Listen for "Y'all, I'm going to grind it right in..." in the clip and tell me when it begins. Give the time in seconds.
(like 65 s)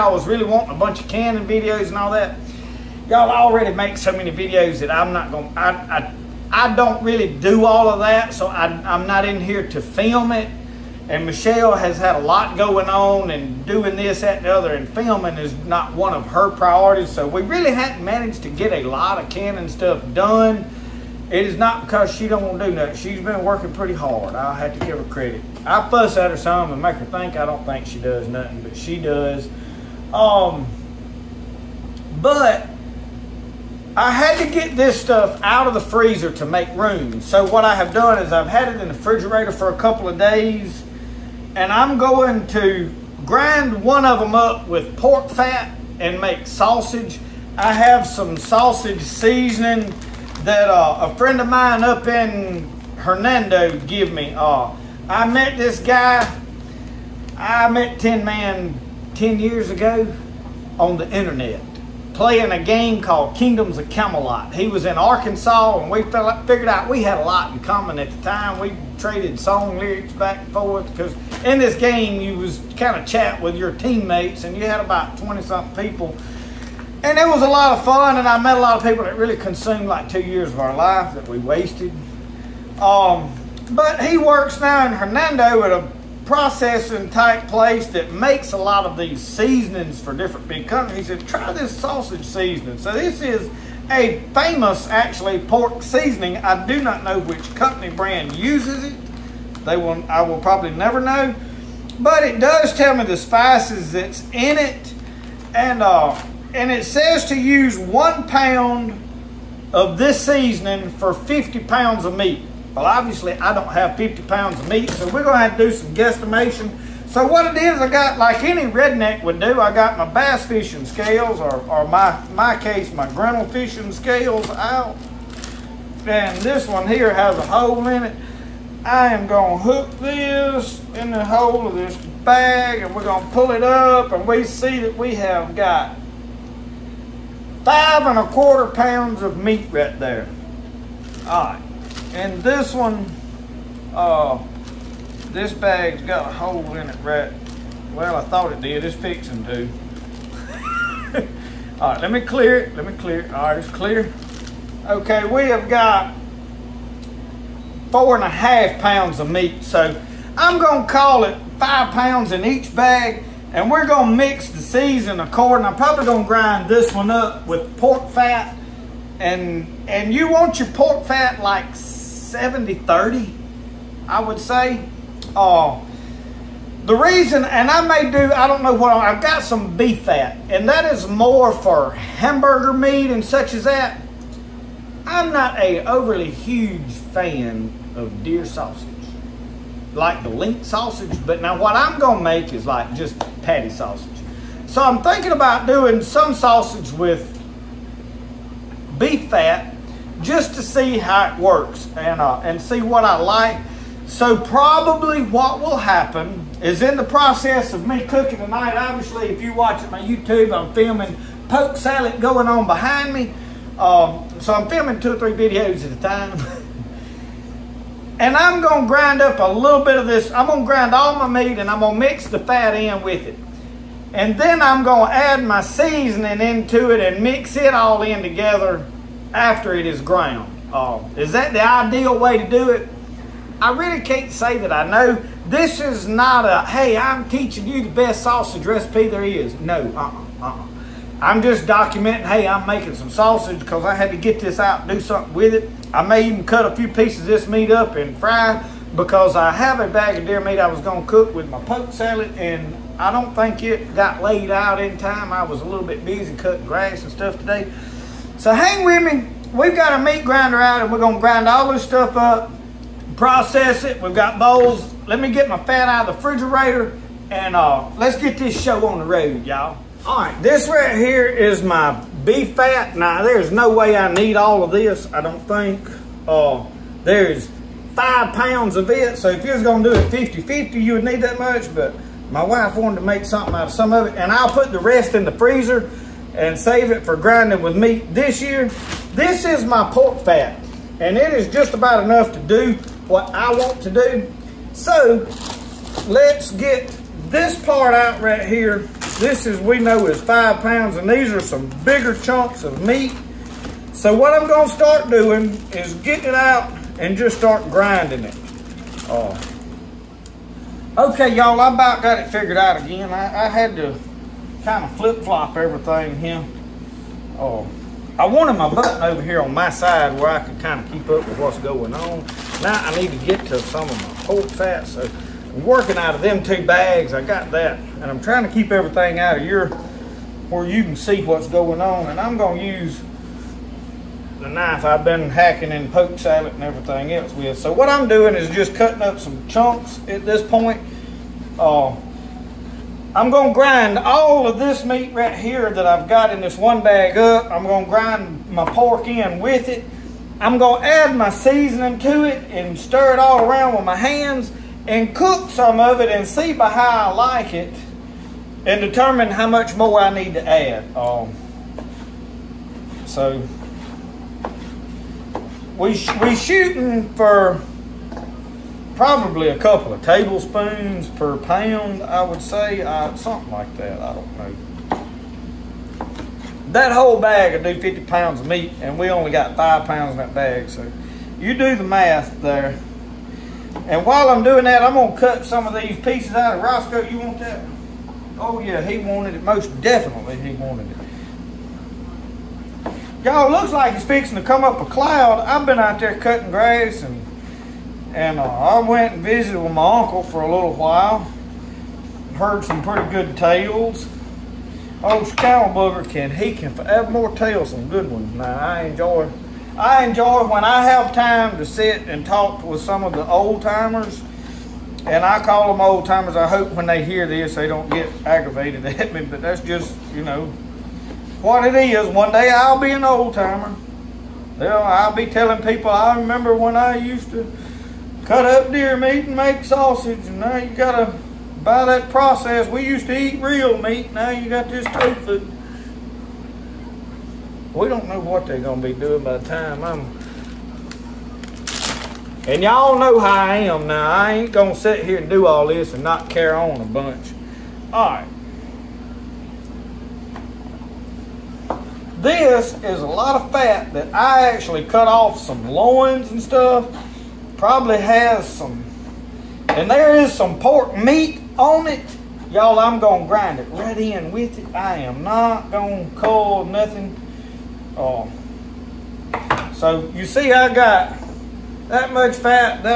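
462 s.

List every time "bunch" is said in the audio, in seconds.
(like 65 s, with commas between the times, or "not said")
0 s, 446 s.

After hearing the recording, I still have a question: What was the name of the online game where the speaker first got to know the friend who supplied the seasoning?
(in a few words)
Kingdoms of Camelot.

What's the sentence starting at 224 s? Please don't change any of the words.
And then I'm going to add my seasoning into it and mix it all in together after it is ground.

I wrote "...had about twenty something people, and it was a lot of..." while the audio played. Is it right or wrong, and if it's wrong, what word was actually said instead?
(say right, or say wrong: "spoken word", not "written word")
right.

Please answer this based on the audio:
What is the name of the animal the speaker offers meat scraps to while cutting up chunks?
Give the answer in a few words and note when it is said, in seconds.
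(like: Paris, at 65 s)
Roscoe, at 386 s.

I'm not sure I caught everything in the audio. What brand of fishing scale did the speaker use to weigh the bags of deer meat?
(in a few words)
Grinnell.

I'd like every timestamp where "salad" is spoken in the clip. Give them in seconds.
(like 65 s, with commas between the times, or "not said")
211 s, 251 s, 336 s.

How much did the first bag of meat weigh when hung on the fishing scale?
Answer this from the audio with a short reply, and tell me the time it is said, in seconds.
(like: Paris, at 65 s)
5 1/4 pounds, at 137 s.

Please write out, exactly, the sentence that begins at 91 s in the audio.
He said, try this sausage seasoning.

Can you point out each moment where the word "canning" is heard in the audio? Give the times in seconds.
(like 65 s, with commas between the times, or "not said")
1 s, 19 s.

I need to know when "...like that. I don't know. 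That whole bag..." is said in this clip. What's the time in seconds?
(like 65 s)
373 s.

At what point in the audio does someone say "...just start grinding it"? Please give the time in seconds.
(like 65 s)
307 s.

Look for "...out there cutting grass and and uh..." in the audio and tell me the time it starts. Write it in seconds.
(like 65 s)
395 s.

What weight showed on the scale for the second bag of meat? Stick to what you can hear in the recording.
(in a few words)
4 1/2 pounds.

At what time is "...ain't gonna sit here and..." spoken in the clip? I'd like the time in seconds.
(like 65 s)
444 s.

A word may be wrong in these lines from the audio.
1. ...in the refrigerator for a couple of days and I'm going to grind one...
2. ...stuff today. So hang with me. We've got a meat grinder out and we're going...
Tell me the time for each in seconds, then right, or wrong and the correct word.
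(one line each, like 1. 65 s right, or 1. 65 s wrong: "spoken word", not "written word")
1. 38 s right
2. 257 s right.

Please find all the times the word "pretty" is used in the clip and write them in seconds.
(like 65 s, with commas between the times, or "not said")
23 s, 402 s.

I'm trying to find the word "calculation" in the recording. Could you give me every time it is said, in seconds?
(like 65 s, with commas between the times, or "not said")
not said.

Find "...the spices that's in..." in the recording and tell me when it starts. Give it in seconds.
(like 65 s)
103 s.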